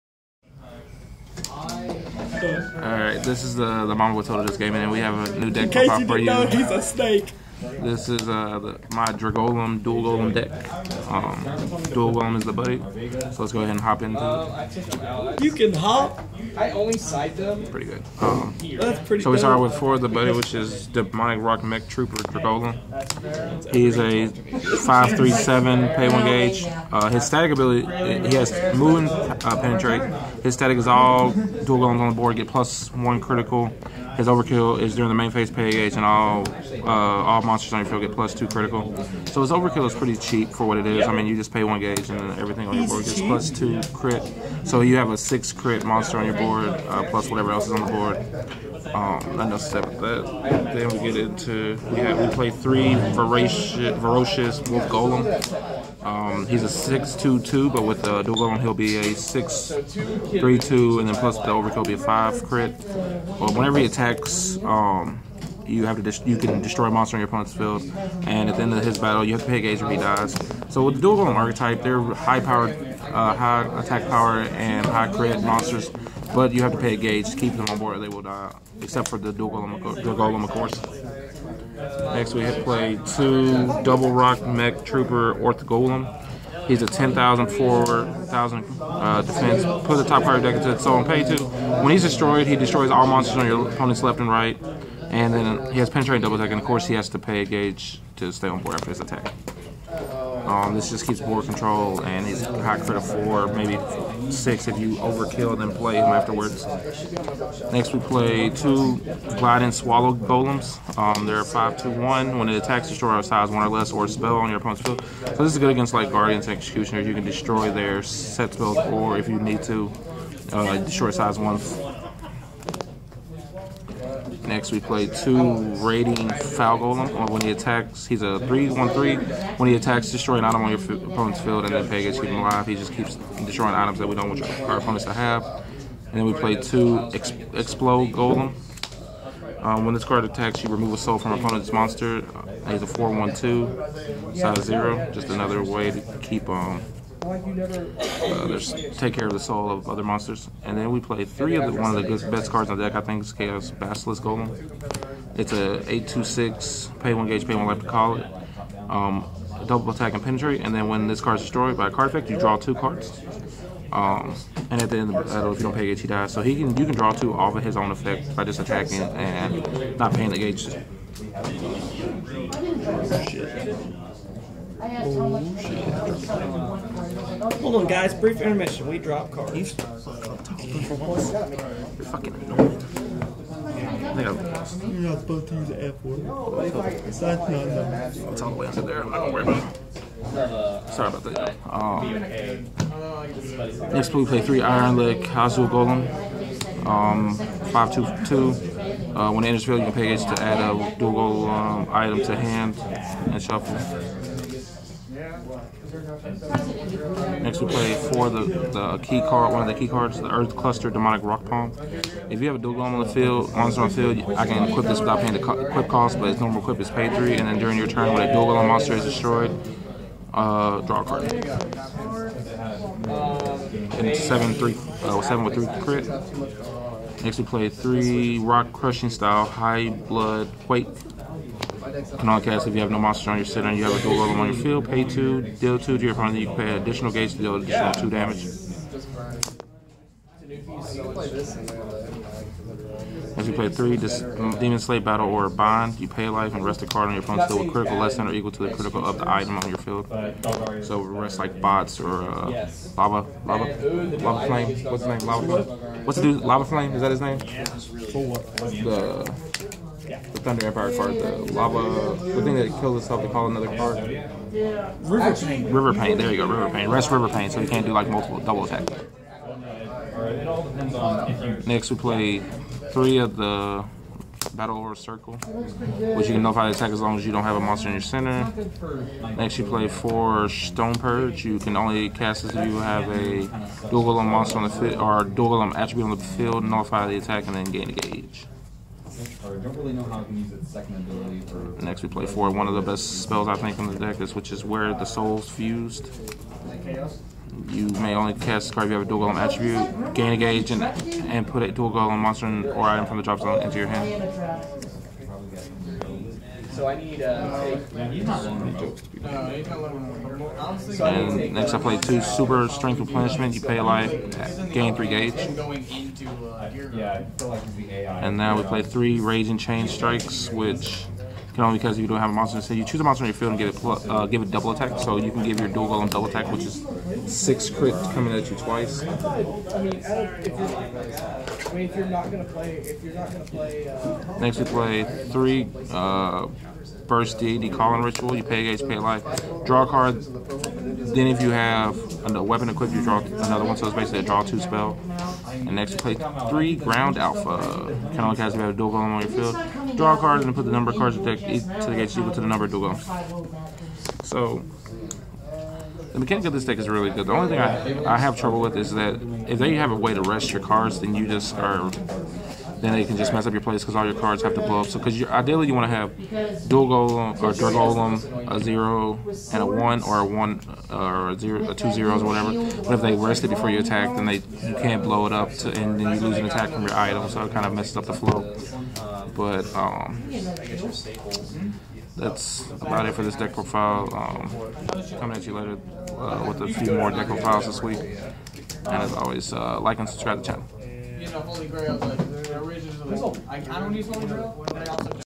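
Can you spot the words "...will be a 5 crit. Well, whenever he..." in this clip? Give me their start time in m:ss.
1:01.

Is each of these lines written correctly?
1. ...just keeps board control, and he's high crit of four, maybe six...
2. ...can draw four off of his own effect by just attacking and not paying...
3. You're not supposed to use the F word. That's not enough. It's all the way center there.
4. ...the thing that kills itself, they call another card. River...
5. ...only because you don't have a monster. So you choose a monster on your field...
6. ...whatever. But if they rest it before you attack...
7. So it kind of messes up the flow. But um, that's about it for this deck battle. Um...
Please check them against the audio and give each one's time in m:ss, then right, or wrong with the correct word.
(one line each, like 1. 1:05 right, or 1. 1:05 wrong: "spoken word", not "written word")
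1. 1:40 right
2. 2:46 wrong: "two", not "four"
3. 3:04 wrong: "under", not "center"
4. 4:22 right
5. 5:21 right
6. 6:12 right
7. 6:17 wrong: "profile", not "battle".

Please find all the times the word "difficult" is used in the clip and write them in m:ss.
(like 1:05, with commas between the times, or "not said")
not said.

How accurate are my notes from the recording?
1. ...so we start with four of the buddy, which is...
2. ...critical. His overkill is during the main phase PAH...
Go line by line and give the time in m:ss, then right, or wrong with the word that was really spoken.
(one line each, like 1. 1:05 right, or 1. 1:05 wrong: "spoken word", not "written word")
1. 0:19 right
2. 0:33 right.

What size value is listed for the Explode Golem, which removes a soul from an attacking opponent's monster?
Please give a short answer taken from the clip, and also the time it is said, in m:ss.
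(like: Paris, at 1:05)
0, at 2:24.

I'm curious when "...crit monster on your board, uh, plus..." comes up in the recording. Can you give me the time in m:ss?
0:45.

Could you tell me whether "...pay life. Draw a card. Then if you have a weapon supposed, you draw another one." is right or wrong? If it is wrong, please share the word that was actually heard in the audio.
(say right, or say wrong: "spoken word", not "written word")
wrong: "equipped", not "supposed".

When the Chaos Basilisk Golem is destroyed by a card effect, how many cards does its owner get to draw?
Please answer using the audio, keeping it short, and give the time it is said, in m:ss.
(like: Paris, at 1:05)
2, at 2:42.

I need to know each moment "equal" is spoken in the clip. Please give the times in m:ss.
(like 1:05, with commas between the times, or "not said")
4:08, 5:52.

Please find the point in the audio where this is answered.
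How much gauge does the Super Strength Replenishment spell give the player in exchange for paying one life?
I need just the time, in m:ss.
5:14.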